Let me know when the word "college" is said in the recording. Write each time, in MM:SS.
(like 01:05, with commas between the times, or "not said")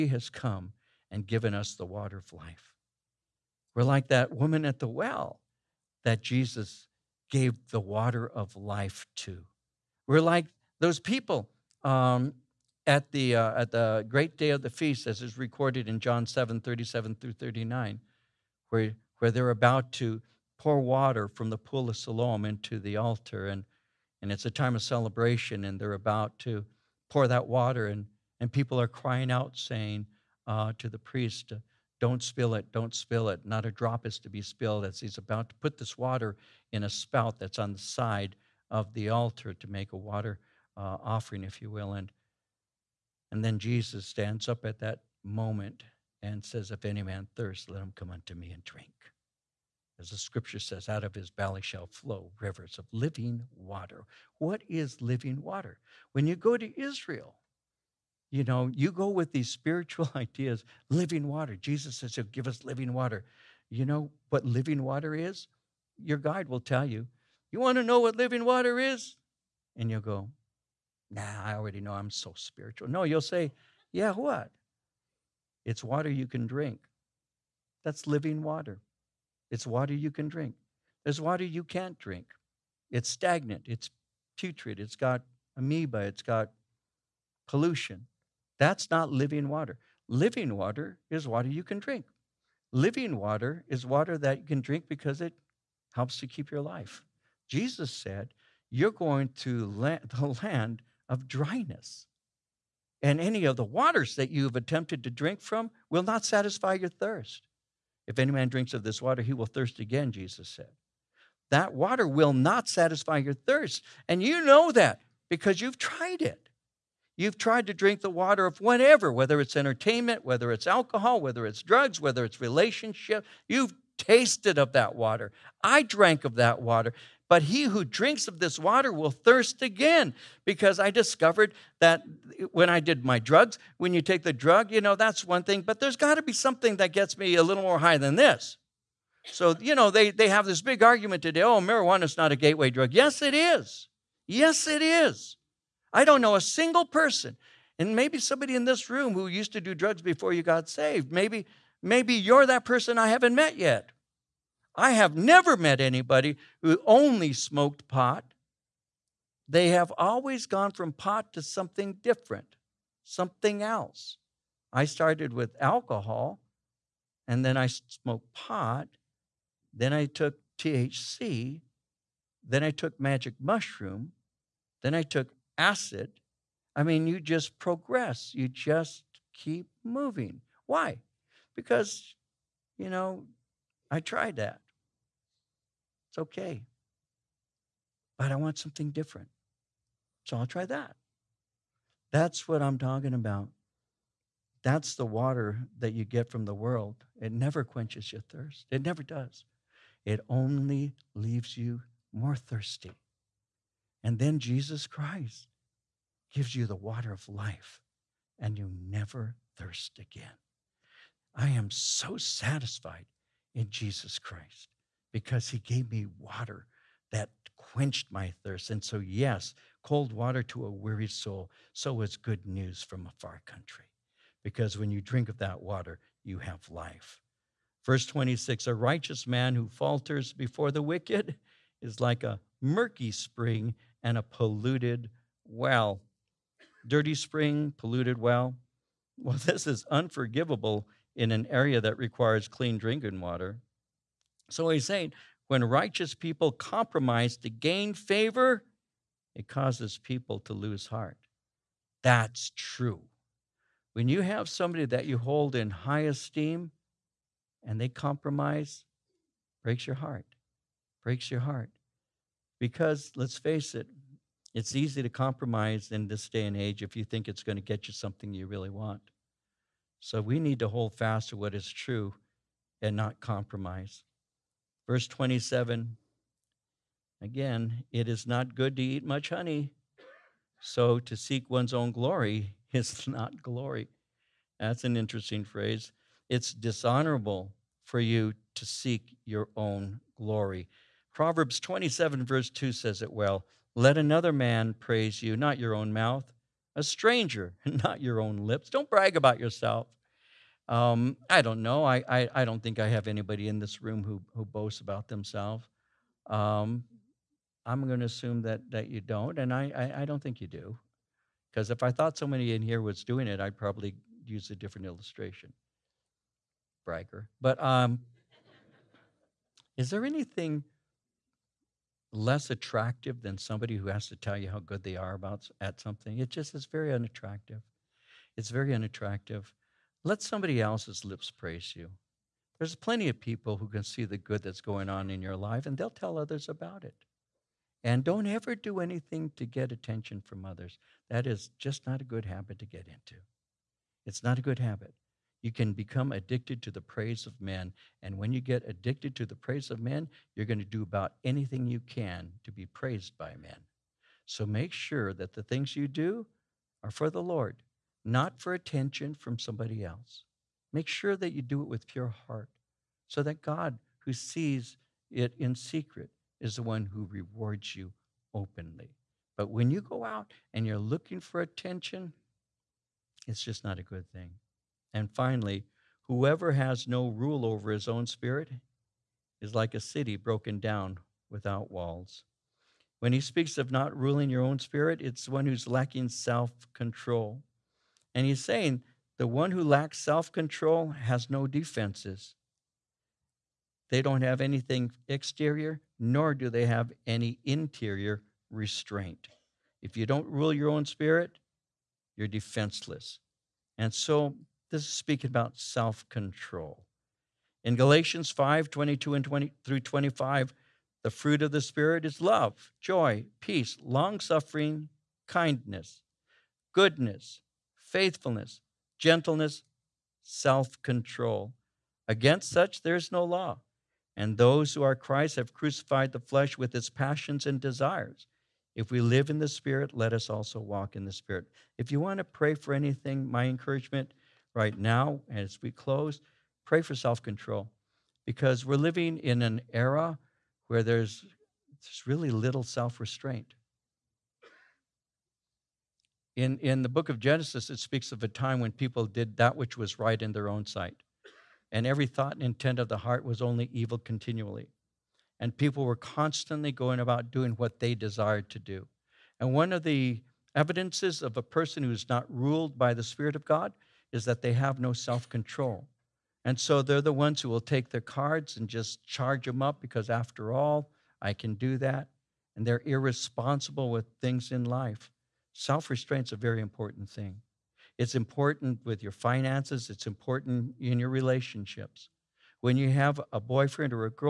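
not said.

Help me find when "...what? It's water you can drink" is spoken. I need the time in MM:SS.
01:14.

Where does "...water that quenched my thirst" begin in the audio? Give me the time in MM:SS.
03:36.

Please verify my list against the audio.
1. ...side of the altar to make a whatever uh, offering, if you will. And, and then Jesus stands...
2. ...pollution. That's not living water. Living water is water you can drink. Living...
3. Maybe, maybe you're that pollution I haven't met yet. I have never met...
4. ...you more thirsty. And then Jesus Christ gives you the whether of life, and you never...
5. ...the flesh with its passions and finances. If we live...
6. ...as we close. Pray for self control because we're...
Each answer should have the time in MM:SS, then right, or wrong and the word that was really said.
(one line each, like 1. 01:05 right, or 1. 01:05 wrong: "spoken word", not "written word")
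1. 00:37 wrong: "water", not "whatever"
2. 01:27 right
3. 02:31 wrong: "person", not "pollution"
4. 03:21 wrong: "water", not "whether"
5. 07:06 wrong: "desires", not "finances"
6. 07:15 right.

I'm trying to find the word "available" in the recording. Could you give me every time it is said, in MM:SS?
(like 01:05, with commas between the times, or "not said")
not said.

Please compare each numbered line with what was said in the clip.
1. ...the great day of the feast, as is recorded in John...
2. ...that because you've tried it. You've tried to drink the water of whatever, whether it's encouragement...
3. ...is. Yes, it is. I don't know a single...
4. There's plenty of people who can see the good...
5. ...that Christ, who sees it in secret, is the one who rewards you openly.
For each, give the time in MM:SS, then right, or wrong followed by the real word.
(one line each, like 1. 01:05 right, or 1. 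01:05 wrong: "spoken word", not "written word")
1. 00:13 right
2. 01:54 wrong: "entertainment", not "encouragement"
3. 02:23 right
4. 05:32 right
5. 06:03 wrong: "God", not "Christ".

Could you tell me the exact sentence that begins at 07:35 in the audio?
And people were constantly going about doing what they desired to do.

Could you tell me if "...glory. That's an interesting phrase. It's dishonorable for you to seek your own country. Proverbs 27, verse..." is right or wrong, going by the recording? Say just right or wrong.
wrong.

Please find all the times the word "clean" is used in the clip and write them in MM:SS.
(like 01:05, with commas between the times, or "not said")
04:02.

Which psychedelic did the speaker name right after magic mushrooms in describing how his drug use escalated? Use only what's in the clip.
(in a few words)
Acid.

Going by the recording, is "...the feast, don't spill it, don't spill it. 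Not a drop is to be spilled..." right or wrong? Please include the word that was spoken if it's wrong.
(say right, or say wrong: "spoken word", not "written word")
wrong: "priest", not "feast".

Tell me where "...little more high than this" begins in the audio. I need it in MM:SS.
02:17.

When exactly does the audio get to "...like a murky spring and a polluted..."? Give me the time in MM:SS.
03:51.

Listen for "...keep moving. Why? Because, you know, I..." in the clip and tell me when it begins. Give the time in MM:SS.
02:59.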